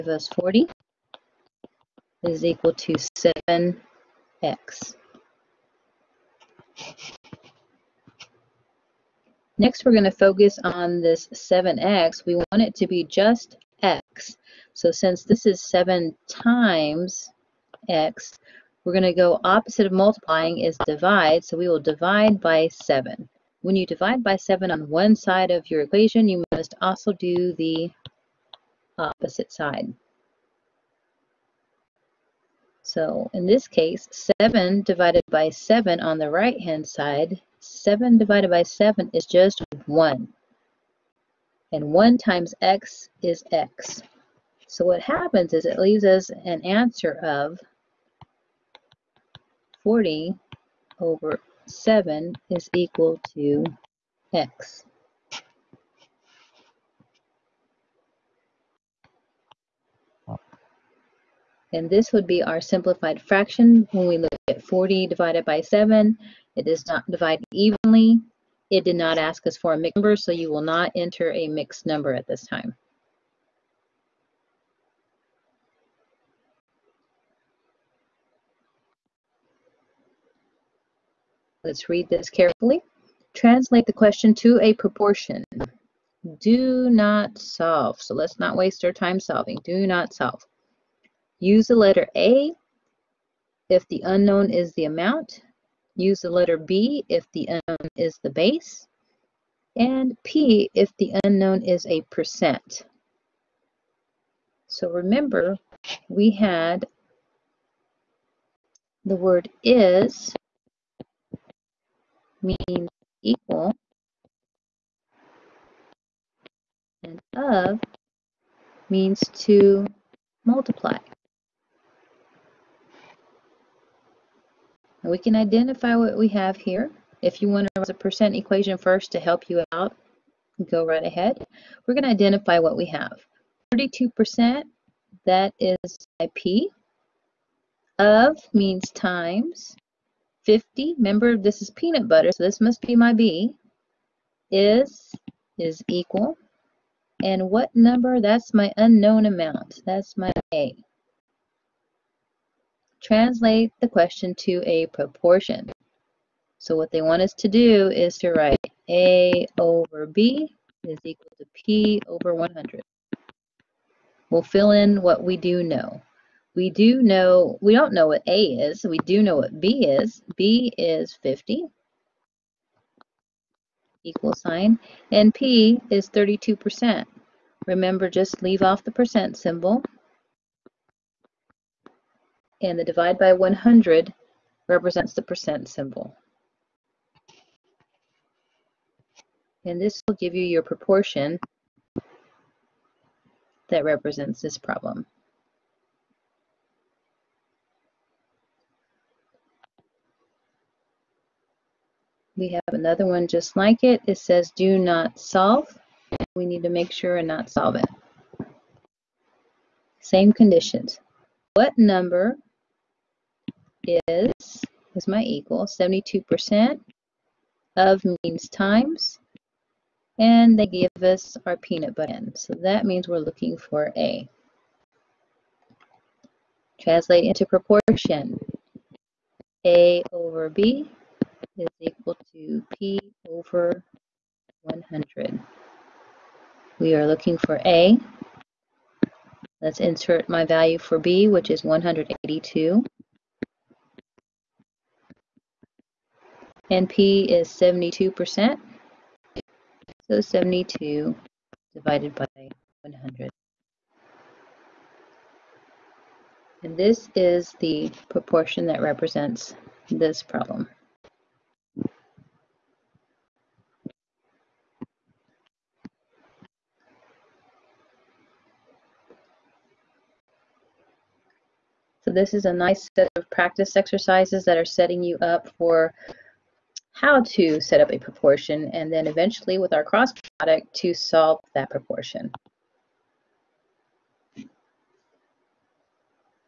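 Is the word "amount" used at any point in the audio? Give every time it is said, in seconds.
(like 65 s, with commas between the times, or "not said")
94 s, 149 s.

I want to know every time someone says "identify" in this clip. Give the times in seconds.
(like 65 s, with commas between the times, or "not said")
125 s, 132 s.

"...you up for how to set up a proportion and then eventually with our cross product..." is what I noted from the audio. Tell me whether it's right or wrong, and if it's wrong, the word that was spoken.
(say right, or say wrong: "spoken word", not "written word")
right.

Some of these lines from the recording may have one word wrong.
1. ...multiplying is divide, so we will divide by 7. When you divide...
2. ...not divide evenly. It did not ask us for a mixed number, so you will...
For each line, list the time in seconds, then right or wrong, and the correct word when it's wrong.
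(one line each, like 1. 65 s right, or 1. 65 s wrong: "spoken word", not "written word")
1. 19 s right
2. 66 s right.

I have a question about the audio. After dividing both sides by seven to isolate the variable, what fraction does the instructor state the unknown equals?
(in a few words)
40/7.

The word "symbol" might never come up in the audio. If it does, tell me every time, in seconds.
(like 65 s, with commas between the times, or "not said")
179 s, 185 s.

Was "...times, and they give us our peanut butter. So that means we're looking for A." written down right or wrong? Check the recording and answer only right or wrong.
right.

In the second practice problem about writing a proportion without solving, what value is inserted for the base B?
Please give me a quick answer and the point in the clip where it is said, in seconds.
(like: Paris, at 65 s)
182, at 241 s.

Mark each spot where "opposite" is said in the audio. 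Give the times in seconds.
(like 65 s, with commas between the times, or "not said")
19 s, 28 s.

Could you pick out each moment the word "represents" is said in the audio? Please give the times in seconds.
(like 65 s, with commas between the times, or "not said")
184 s, 193 s, 258 s.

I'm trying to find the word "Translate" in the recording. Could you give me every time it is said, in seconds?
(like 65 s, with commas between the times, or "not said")
83 s, 153 s, 226 s.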